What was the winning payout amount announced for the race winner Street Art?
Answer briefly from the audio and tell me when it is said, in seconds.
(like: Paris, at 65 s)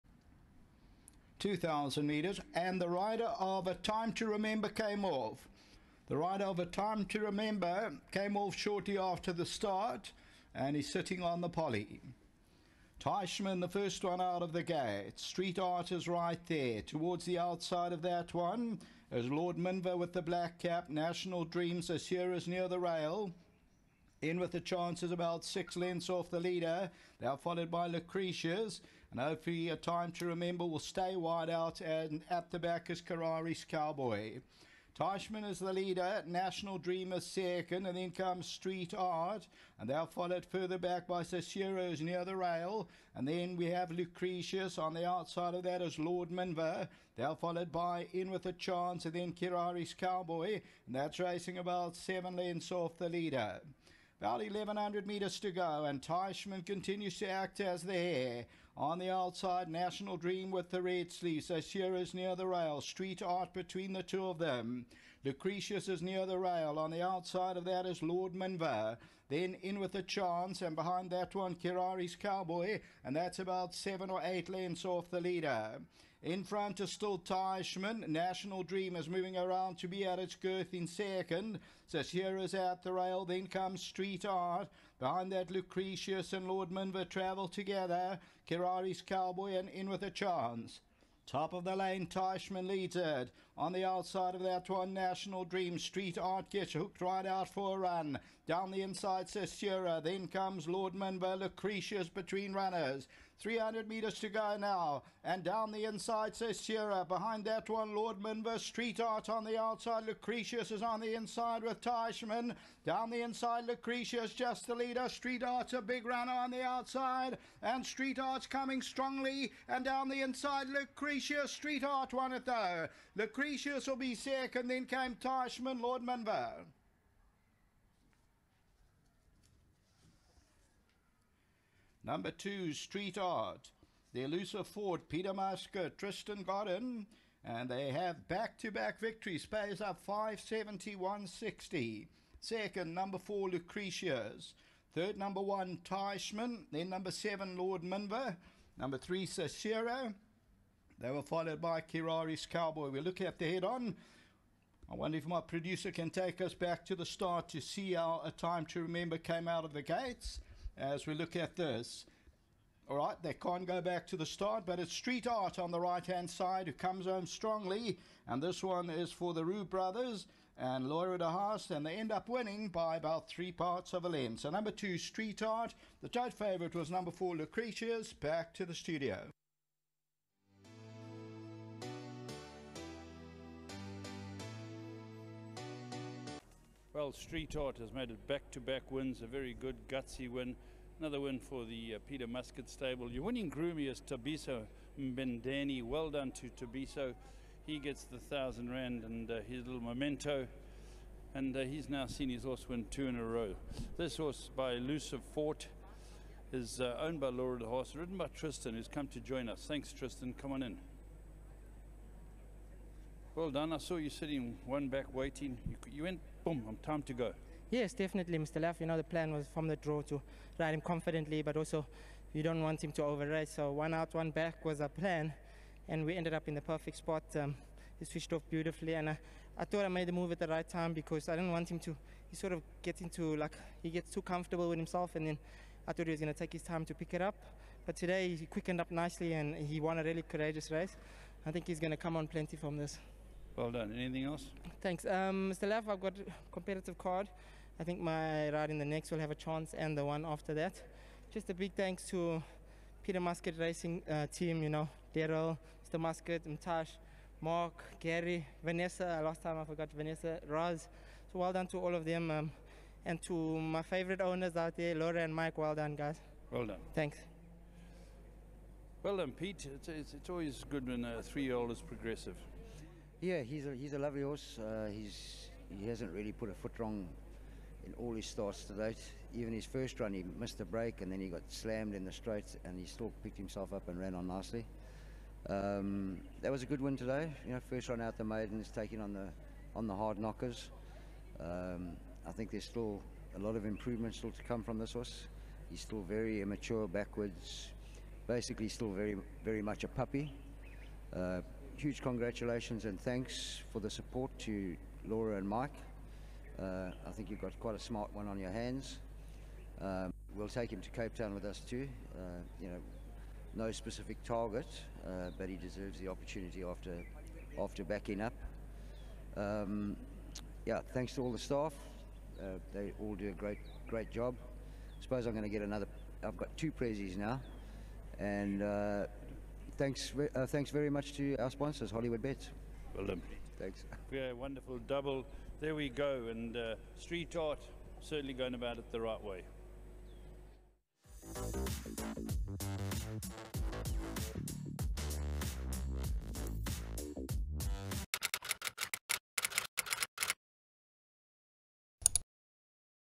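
571.60, at 140 s.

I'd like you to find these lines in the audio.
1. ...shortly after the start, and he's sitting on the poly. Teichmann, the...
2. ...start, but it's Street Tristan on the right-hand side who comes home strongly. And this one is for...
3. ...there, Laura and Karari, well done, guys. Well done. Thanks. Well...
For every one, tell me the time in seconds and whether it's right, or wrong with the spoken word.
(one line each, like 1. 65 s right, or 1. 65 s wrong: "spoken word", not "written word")
1. 8 s right
2. 164 s wrong: "Art", not "Tristan"
3. 264 s wrong: "Mike", not "Karari".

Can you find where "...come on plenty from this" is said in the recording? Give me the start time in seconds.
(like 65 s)
241 s.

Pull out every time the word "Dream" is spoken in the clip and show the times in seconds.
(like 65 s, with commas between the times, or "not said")
21 s, 36 s, 60 s, 78 s, 95 s.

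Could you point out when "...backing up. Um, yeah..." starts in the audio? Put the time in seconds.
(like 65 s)
317 s.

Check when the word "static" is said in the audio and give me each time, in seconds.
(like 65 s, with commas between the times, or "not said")
not said.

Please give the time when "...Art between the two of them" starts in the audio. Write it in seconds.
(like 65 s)
63 s.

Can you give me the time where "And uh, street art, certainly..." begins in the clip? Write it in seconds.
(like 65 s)
336 s.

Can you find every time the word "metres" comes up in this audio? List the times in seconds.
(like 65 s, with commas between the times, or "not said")
55 s, 103 s.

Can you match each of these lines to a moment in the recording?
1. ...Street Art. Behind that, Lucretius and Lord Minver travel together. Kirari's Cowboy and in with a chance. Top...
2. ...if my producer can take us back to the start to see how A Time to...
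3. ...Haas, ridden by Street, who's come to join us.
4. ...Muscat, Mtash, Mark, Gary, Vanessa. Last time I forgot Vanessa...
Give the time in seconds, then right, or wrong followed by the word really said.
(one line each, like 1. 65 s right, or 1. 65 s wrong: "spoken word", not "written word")
1. 83 s right
2. 155 s right
3. 207 s wrong: "Tristan", not "Street"
4. 255 s right.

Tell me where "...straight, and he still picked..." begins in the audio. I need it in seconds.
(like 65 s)
282 s.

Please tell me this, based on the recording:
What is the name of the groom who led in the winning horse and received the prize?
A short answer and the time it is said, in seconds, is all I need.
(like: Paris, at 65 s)
Tabiso Mbendani, at 194 s.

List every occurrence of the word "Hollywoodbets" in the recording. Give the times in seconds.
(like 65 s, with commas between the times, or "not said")
331 s.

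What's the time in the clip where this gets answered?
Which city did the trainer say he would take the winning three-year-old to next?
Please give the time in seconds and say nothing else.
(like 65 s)
310 s.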